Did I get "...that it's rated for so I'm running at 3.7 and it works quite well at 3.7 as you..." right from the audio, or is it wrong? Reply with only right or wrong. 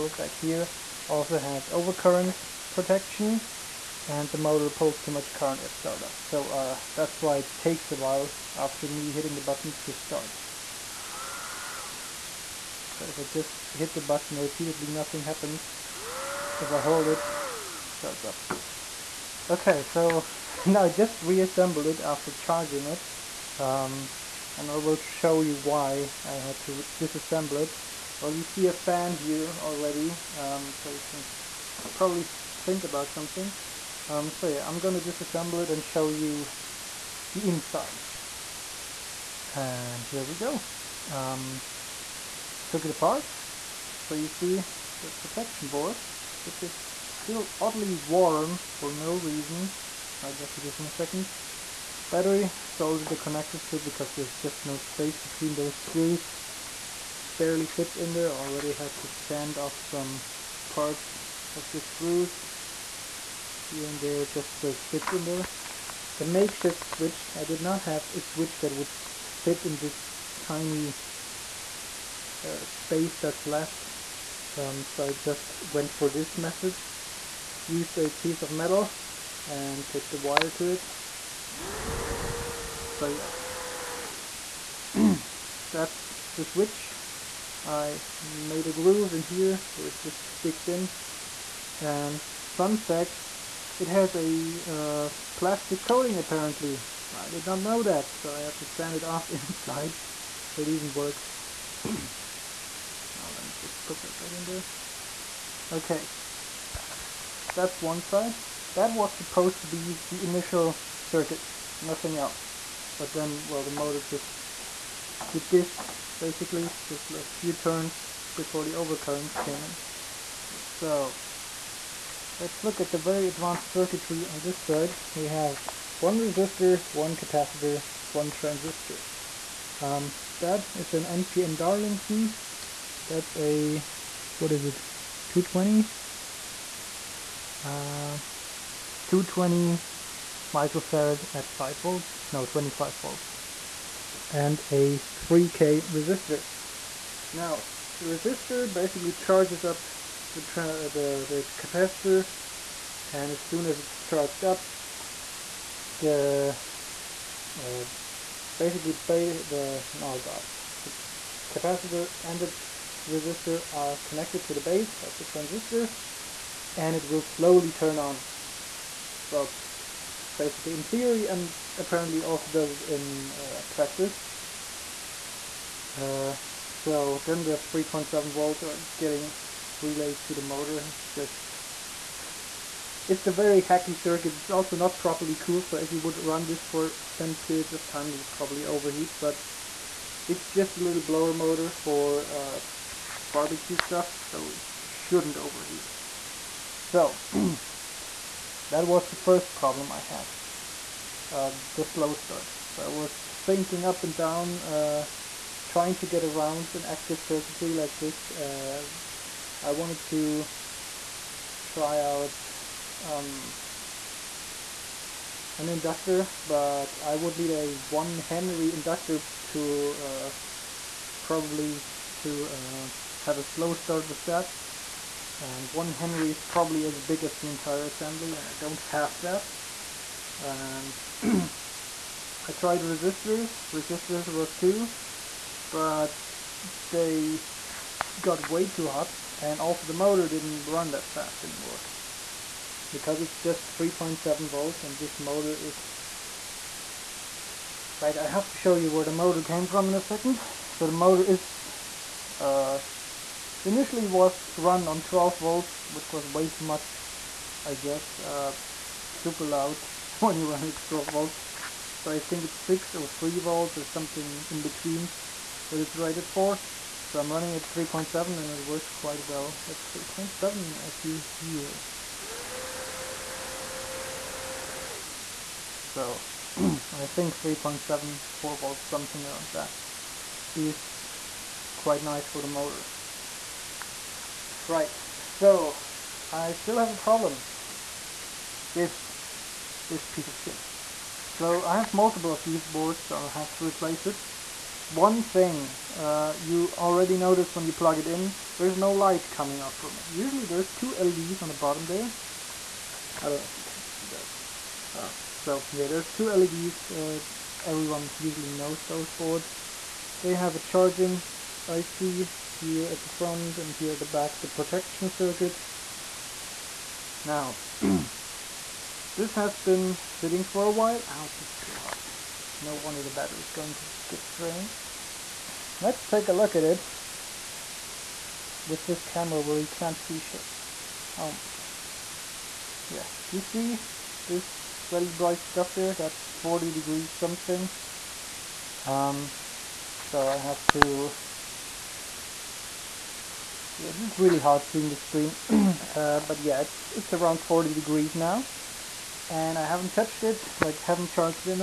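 right.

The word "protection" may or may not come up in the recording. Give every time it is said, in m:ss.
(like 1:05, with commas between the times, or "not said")
0:02, 0:45, 5:14.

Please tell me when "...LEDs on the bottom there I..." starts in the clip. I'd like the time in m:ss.
5:00.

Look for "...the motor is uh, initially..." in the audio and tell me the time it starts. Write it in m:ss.
4:10.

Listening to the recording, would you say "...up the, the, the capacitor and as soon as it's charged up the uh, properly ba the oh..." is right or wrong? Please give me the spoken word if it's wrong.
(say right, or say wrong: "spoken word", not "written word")
wrong: "basically", not "properly".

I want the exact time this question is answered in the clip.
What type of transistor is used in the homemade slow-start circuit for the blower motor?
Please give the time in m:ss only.
2:11.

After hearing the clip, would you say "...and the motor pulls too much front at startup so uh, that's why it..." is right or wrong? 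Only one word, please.
wrong.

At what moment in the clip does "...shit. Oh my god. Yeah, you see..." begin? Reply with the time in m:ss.
5:30.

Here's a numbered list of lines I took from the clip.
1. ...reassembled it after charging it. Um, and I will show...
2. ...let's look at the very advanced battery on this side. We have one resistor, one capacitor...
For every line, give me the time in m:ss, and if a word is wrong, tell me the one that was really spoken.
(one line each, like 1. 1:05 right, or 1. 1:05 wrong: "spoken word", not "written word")
1. 0:21 right
2. 2:02 wrong: "circuitry", not "battery".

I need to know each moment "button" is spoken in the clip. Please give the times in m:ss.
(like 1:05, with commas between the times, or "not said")
0:09, 0:14.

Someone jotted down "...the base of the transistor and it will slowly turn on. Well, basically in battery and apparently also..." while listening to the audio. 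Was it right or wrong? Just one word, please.
wrong.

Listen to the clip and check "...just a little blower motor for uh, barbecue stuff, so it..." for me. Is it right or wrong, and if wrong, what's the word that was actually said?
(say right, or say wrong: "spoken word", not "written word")
right.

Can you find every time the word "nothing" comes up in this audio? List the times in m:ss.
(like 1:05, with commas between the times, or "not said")
0:14, 1:51.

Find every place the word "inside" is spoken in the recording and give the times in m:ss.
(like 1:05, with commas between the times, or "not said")
0:37, 1:39.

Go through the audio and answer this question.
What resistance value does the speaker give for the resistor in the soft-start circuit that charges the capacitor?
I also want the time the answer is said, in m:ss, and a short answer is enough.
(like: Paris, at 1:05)
3k, at 2:25.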